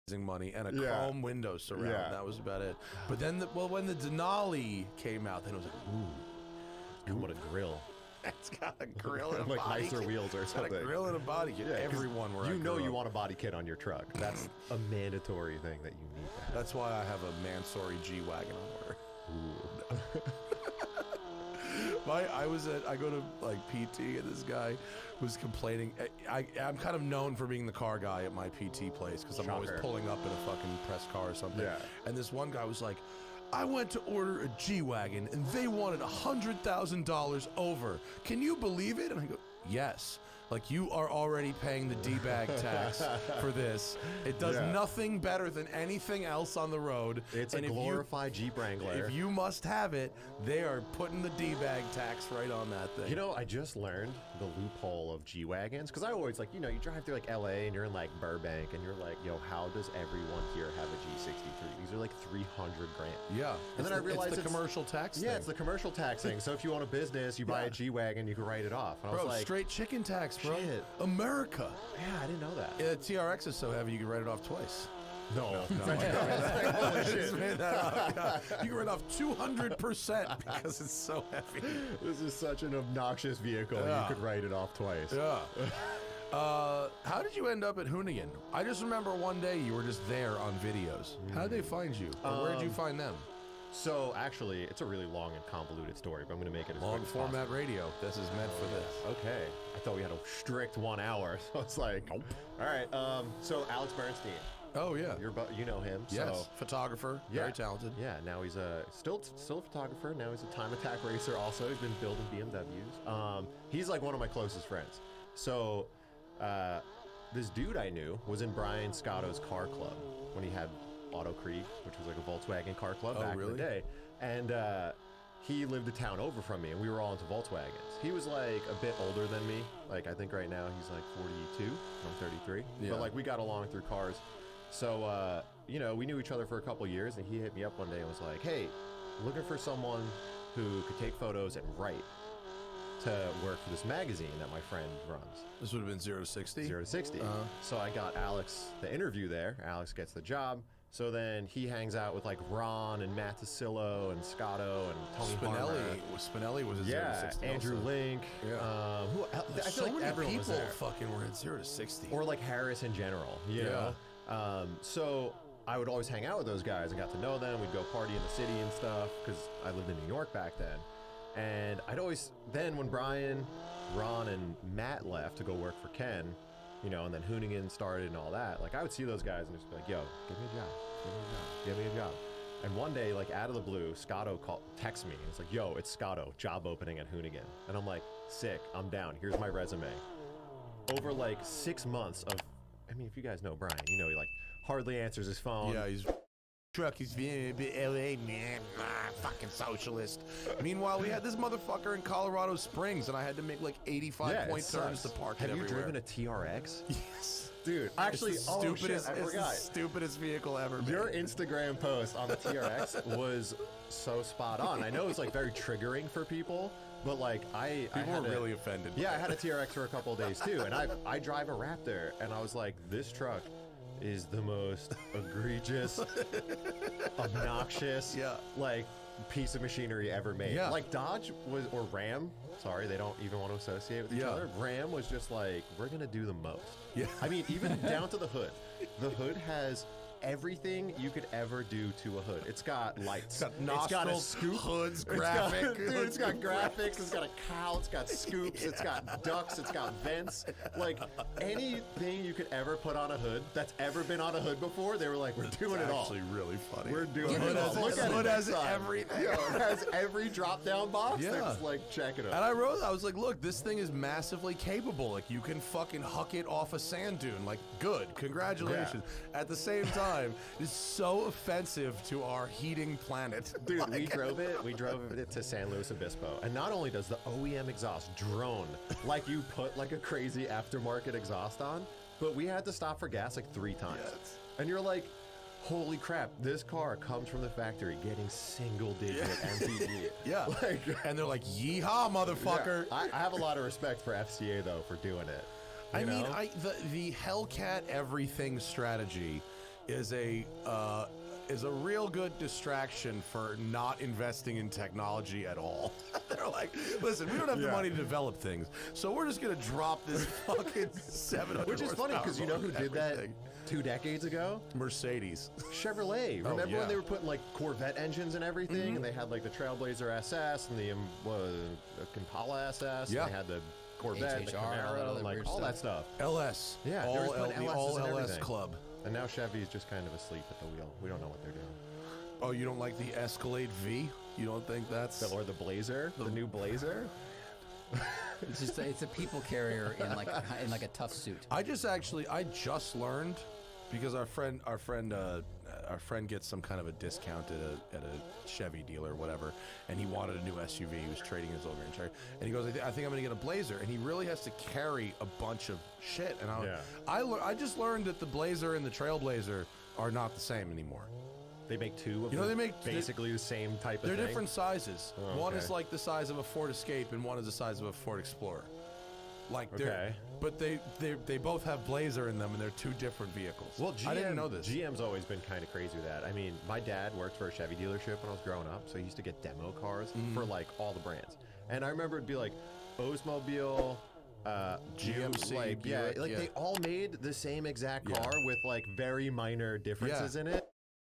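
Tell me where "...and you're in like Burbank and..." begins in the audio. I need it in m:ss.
0:57.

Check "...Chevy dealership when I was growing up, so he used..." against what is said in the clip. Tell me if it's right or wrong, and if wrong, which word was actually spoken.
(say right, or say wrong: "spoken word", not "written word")
right.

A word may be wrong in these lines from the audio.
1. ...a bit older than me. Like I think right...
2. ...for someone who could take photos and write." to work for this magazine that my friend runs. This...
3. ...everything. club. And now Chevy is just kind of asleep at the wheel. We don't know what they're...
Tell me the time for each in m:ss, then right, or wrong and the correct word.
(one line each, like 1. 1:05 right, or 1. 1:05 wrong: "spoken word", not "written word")
1. 2:08 right
2. 2:19 right
3. 5:28 right.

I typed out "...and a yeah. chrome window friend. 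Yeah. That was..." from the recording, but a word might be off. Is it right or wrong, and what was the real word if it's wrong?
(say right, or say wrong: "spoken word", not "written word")
wrong: "surround", not "friend".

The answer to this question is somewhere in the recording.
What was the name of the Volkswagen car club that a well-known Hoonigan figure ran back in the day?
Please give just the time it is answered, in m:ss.
2:01.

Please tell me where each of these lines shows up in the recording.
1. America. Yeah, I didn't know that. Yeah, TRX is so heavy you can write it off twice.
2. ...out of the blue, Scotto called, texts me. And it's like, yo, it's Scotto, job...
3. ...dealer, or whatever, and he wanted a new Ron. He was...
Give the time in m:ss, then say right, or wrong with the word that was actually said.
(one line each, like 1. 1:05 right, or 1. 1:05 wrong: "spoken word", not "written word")
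1. 1:10 right
2. 3:03 right
3. 5:48 wrong: "SUV", not "Ron".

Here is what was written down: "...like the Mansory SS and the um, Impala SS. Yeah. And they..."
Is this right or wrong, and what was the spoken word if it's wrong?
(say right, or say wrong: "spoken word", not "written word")
wrong: "Trailblazer", not "Mansory".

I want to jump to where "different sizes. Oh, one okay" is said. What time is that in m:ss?
6:04.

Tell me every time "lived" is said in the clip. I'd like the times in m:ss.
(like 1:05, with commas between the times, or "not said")
2:05, 2:49.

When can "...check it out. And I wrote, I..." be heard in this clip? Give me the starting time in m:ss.
4:21.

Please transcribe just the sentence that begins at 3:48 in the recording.
like piece of machinery ever made.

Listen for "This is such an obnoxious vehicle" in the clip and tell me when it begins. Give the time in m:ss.
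1:22.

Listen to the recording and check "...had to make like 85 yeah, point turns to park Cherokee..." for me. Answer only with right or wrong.
wrong.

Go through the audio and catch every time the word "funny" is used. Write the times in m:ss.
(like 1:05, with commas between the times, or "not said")
4:16, 5:11.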